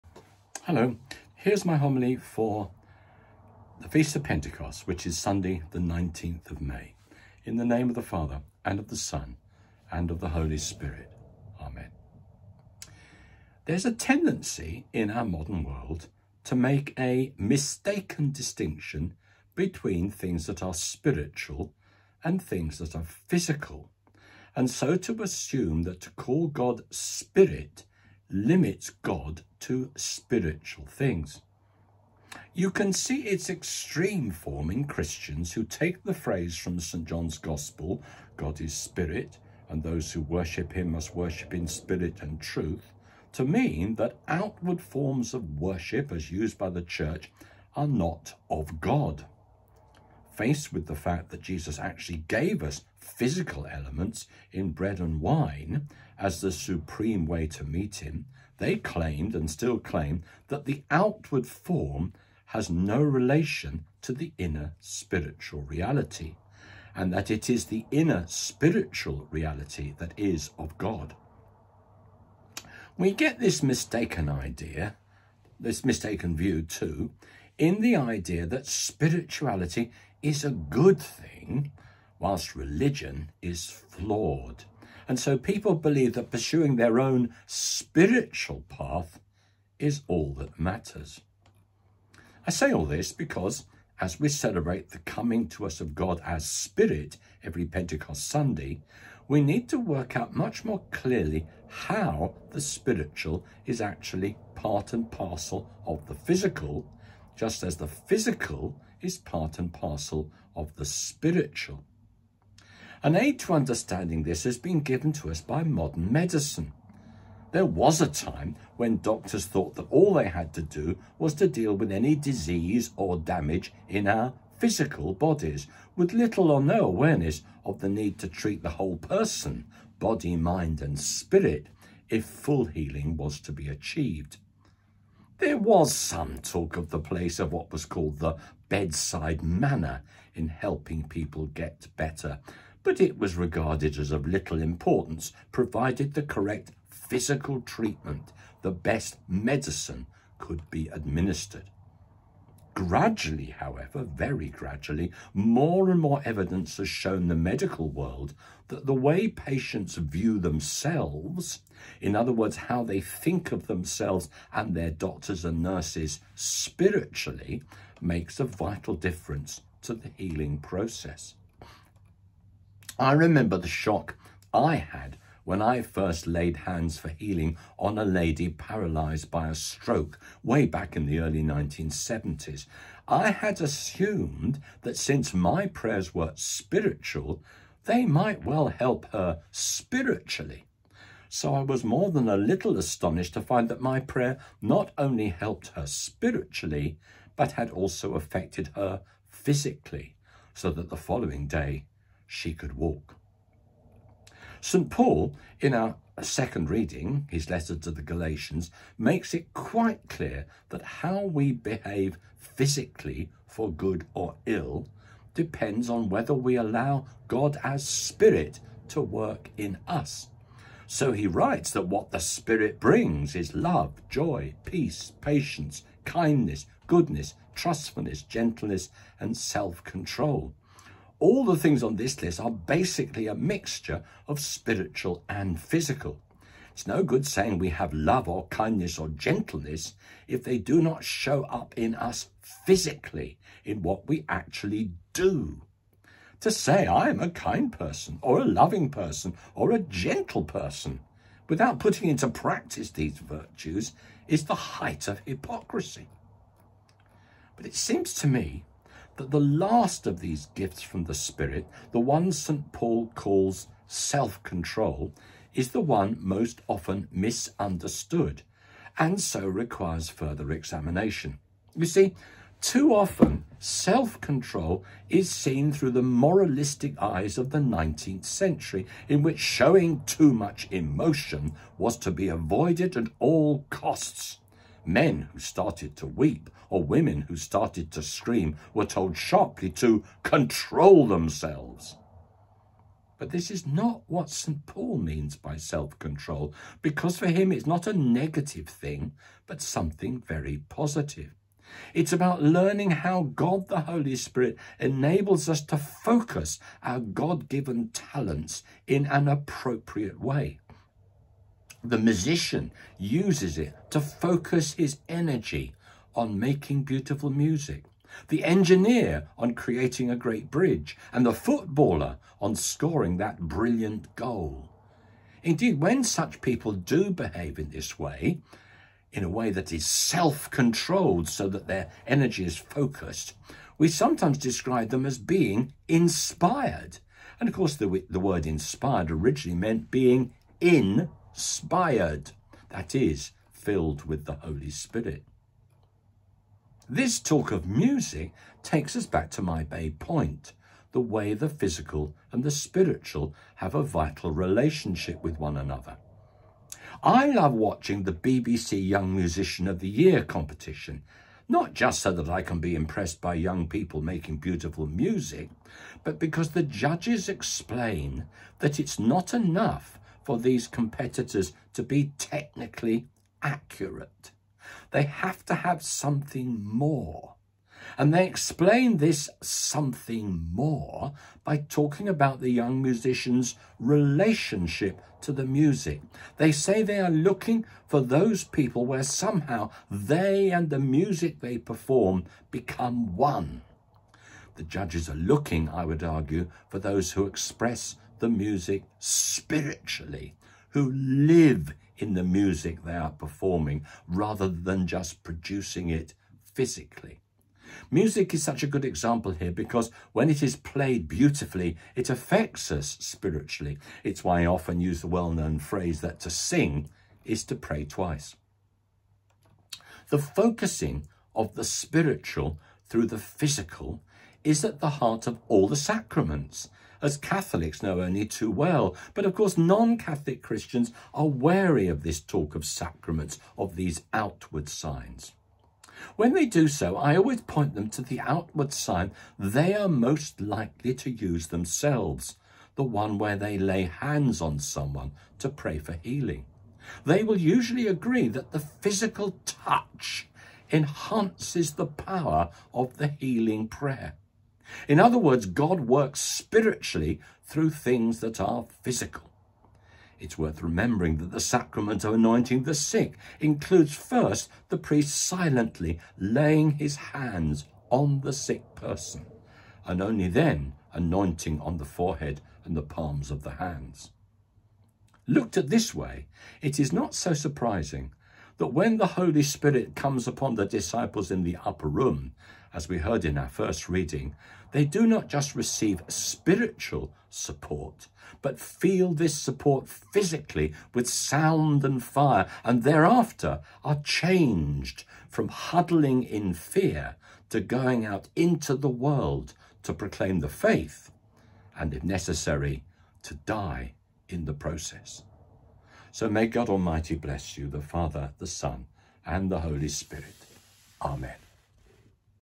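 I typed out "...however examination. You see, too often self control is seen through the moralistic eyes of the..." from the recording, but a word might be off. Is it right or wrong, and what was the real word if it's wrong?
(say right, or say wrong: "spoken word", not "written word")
wrong: "further", not "however".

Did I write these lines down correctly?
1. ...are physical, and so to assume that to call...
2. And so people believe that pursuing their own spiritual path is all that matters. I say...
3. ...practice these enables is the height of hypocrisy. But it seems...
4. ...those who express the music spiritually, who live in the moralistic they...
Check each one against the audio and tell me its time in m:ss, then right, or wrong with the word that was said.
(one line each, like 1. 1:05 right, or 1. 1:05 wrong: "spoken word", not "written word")
1. 0:22 right
2. 1:25 right
3. 4:12 wrong: "virtues", not "enables"
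4. 6:36 wrong: "music", not "moralistic".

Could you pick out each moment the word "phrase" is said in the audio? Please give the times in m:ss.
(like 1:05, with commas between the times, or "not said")
0:36, 6:55.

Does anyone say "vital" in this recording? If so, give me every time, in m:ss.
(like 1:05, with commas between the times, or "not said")
2:48, 5:53.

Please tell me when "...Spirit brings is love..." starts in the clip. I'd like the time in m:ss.
3:42.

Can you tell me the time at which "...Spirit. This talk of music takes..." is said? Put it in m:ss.
5:44.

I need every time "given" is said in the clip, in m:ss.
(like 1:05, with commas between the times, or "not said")
1:54, 5:07.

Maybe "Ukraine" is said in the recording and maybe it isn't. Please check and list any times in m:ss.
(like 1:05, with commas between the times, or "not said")
not said.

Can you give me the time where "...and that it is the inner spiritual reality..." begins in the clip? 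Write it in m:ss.
1:06.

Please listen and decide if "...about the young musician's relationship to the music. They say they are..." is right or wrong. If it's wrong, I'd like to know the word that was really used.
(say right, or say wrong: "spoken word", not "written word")
right.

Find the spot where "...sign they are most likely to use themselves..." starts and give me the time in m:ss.
7:18.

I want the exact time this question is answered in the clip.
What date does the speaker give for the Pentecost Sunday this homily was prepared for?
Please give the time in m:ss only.
0:05.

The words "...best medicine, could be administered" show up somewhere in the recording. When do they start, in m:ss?
2:28.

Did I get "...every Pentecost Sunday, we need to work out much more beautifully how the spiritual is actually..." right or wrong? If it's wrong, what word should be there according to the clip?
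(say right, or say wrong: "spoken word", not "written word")
wrong: "clearly", not "beautifully".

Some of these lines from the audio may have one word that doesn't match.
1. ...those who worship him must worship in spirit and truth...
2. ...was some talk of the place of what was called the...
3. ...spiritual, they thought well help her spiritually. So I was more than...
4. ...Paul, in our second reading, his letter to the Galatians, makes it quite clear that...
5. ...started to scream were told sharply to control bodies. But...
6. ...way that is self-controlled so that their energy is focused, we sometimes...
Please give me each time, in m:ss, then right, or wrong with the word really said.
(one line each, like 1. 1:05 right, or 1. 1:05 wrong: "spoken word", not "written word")
1. 0:39 right
2. 2:15 right
3. 3:06 wrong: "might", not "thought"
4. 3:24 right
5. 4:47 wrong: "themselves", not "bodies"
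6. 5:29 right.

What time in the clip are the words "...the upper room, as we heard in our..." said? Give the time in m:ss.
8:01.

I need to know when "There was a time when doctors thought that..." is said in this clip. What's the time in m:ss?
1:57.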